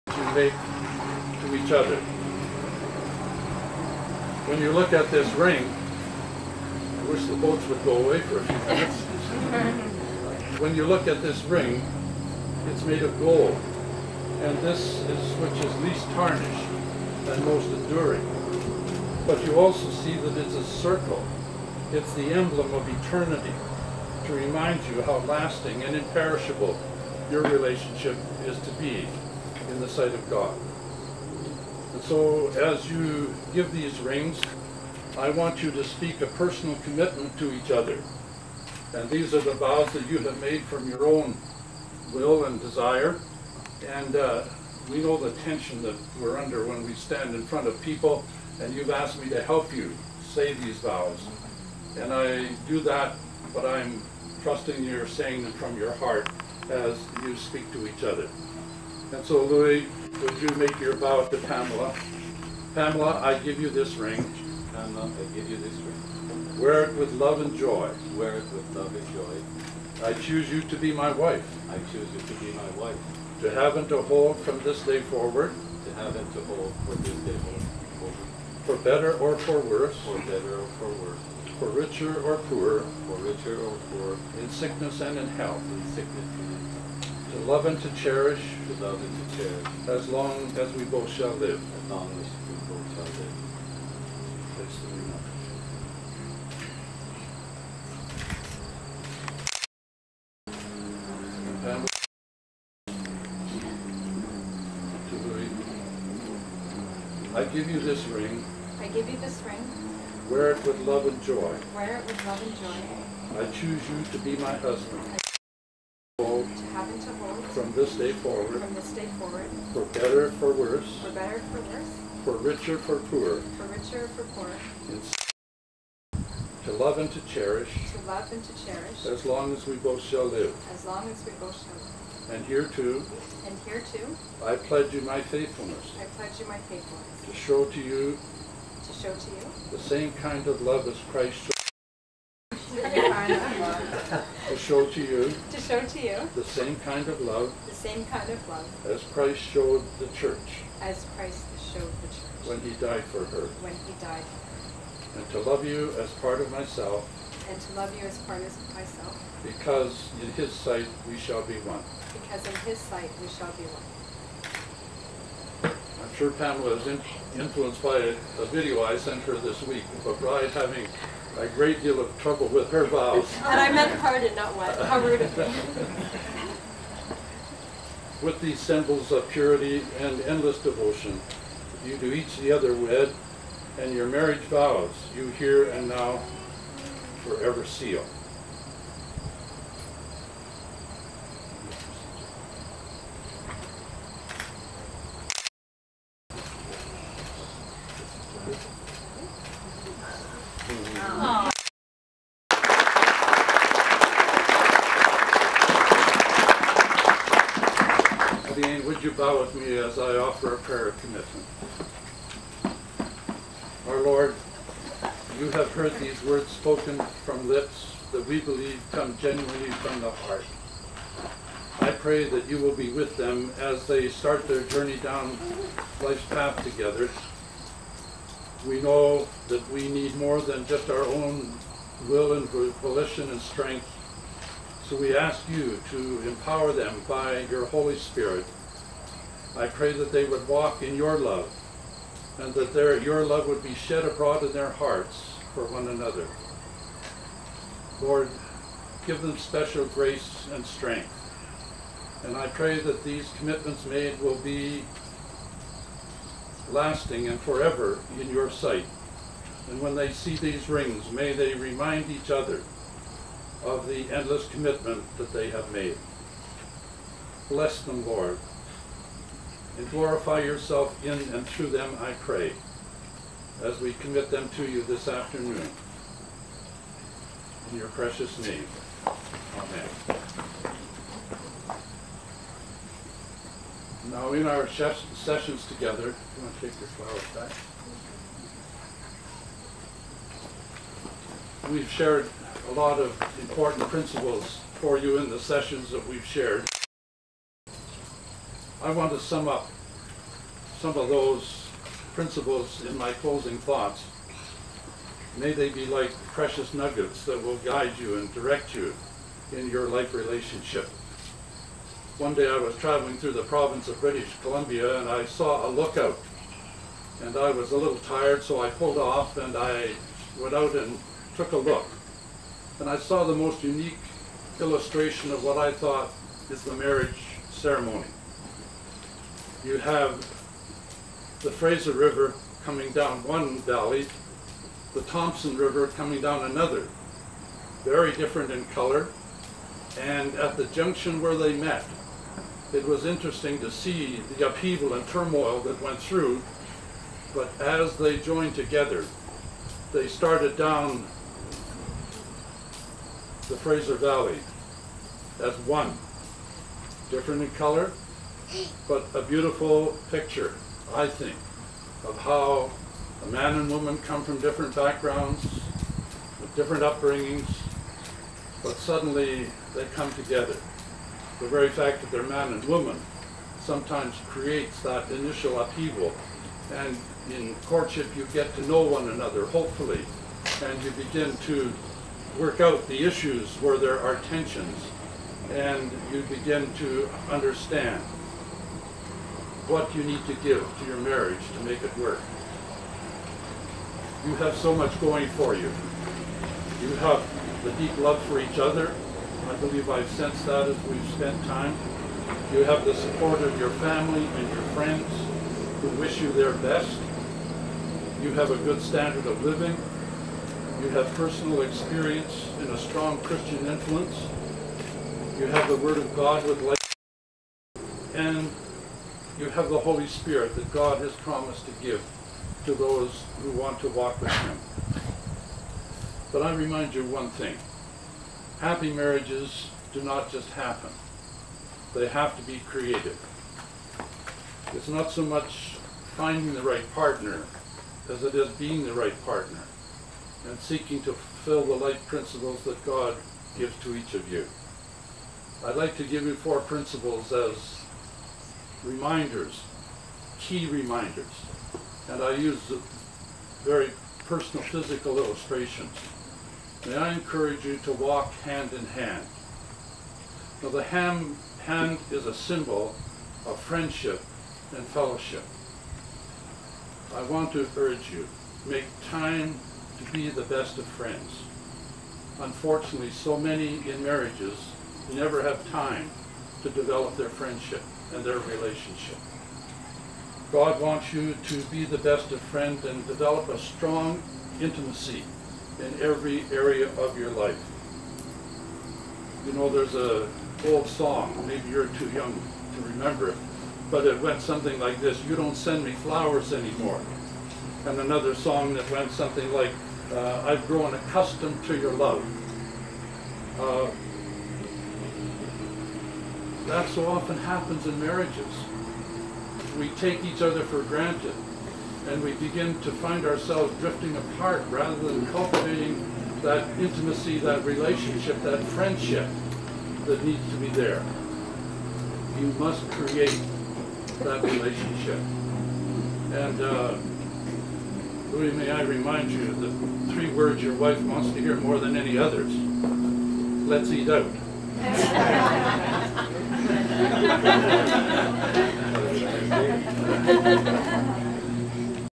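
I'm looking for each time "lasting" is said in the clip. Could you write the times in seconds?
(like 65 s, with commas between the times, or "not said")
25 s, 256 s.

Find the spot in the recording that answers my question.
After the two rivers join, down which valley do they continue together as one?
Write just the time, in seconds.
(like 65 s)
353 s.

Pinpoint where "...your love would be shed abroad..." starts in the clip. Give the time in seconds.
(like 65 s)
243 s.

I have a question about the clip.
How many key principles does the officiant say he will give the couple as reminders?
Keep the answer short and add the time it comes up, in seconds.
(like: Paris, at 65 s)
4, at 446 s.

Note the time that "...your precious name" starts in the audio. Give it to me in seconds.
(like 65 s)
277 s.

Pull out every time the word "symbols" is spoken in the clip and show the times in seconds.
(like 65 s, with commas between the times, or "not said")
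178 s, 462 s.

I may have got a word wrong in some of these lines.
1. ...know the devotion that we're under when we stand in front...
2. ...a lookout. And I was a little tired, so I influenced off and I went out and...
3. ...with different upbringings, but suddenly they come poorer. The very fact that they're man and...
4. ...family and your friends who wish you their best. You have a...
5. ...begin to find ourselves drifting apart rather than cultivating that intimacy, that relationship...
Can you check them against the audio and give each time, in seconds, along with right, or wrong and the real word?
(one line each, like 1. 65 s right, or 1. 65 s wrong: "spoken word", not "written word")
1. 45 s wrong: "tension", not "devotion"
2. 315 s wrong: "pulled", not "influenced"
3. 366 s wrong: "together", not "poorer"
4. 403 s right
5. 512 s right.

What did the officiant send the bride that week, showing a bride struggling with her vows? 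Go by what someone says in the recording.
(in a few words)
A video.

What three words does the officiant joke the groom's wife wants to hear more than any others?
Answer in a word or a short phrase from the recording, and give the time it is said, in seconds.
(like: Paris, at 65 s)
Let's eat out, at 533 s.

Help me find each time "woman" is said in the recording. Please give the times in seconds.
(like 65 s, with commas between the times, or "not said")
363 s, 372 s.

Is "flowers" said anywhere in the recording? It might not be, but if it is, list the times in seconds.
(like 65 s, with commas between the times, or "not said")
286 s, 495 s.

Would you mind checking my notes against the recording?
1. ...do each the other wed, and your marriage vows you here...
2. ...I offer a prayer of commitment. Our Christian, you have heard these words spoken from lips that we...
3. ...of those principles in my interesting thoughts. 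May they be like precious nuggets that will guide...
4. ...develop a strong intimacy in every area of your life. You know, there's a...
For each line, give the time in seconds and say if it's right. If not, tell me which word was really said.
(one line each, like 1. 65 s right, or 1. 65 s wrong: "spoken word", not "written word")
1. 181 s right
2. 209 s wrong: "Lord", not "Christian"
3. 300 s wrong: "closing", not "interesting"
4. 483 s right.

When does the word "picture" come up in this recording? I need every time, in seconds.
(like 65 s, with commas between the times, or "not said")
360 s.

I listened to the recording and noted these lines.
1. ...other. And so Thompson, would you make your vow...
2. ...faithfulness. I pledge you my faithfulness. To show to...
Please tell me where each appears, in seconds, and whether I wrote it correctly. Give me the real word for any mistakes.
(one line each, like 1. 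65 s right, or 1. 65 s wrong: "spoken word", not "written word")
1. 58 s wrong: "Louis", not "Thompson"
2. 135 s right.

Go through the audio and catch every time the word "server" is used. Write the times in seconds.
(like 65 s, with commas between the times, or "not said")
not said.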